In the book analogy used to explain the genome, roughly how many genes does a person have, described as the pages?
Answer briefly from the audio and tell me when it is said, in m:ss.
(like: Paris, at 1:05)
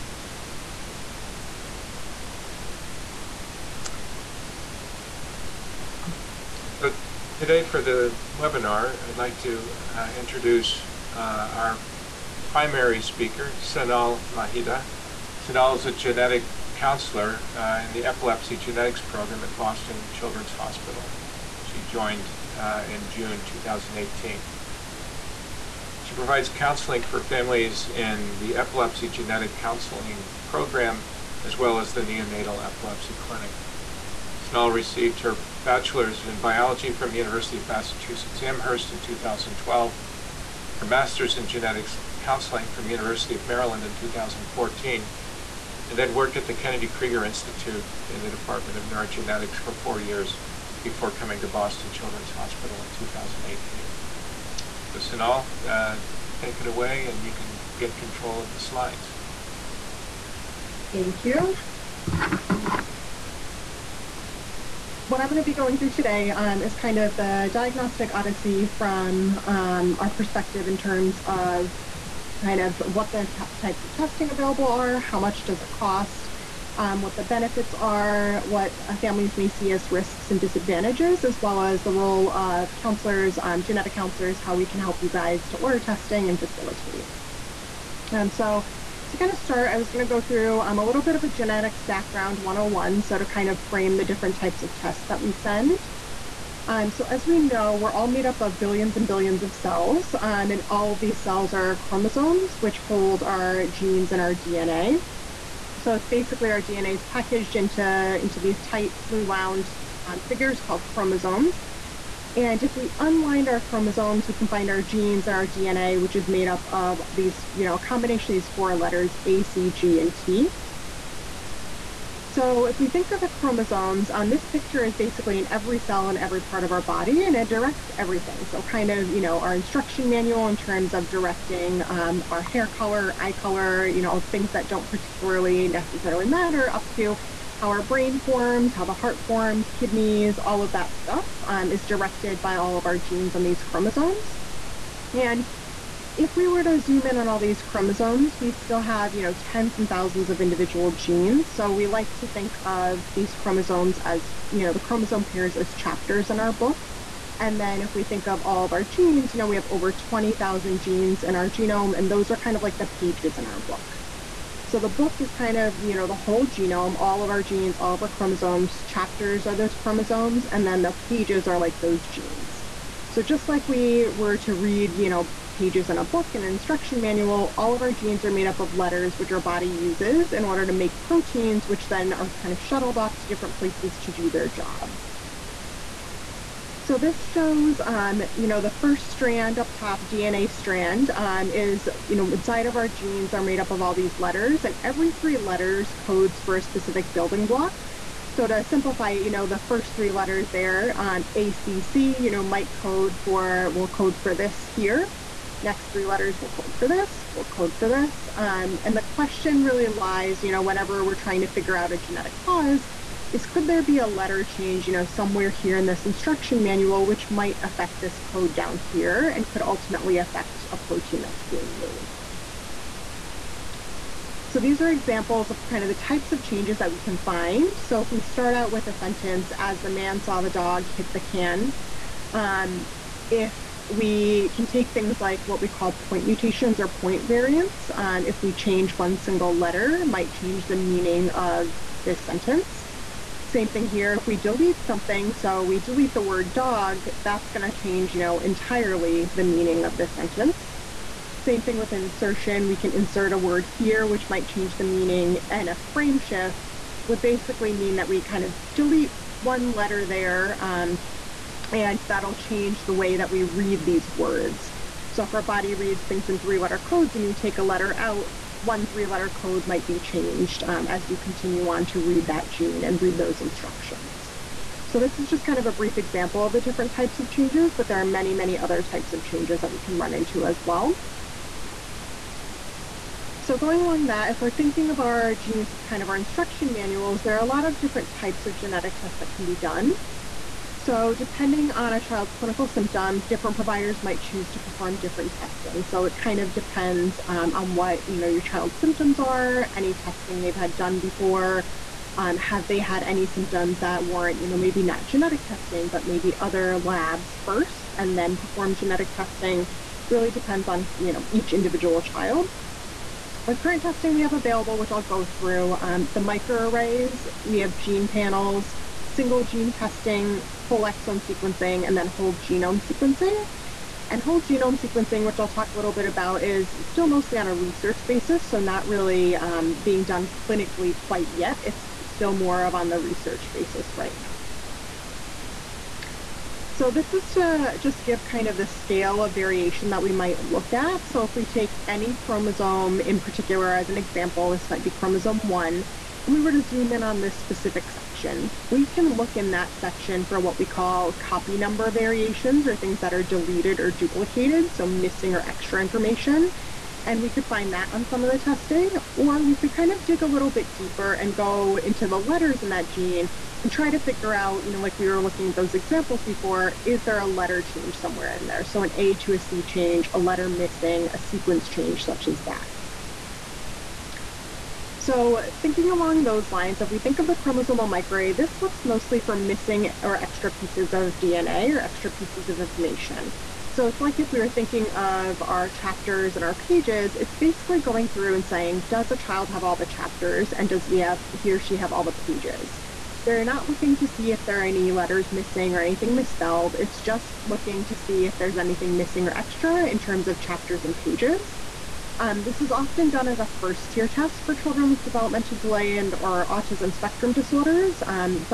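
over 20,000, at 2:39.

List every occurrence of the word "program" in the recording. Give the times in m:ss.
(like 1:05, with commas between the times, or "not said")
0:19, 0:30.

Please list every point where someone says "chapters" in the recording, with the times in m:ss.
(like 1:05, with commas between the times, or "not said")
2:35, 2:48, 6:25, 6:29, 6:40.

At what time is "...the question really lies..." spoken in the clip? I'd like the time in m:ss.
3:28.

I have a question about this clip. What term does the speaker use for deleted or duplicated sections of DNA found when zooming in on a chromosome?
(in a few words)
copy number variations.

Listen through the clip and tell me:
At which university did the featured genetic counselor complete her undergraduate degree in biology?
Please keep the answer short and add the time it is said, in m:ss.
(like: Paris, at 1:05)
University of Massachusetts Amherst, at 0:37.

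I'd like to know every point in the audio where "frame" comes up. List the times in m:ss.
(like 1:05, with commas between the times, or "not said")
1:33, 4:15.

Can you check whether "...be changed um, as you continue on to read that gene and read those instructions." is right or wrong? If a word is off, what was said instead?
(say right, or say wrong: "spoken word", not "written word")
right.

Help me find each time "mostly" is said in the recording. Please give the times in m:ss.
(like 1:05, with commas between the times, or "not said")
5:27, 6:18.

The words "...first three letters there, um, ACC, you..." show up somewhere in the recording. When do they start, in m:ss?
3:19.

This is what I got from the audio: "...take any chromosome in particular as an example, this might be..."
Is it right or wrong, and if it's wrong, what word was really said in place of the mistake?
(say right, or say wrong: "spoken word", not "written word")
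right.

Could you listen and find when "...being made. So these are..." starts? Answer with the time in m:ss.
3:41.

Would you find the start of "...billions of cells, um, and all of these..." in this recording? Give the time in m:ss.
1:39.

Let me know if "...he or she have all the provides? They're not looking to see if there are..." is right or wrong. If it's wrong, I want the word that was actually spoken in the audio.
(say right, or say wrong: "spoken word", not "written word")
wrong: "pages", not "provides".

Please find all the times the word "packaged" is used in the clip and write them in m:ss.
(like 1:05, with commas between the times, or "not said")
1:47.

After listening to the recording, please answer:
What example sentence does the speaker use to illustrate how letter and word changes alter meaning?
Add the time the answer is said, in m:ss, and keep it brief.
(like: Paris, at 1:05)
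the man saw the dog hit the can, at 3:49.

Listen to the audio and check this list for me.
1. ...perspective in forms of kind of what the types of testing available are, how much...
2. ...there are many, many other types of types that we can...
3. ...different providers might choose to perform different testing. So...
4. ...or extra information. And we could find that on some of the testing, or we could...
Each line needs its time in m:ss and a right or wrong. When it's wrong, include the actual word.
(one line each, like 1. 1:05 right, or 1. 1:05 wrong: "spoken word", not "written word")
1. 1:10 wrong: "terms", not "forms"
2. 4:37 wrong: "changes", not "types"
3. 4:53 right
4. 5:55 right.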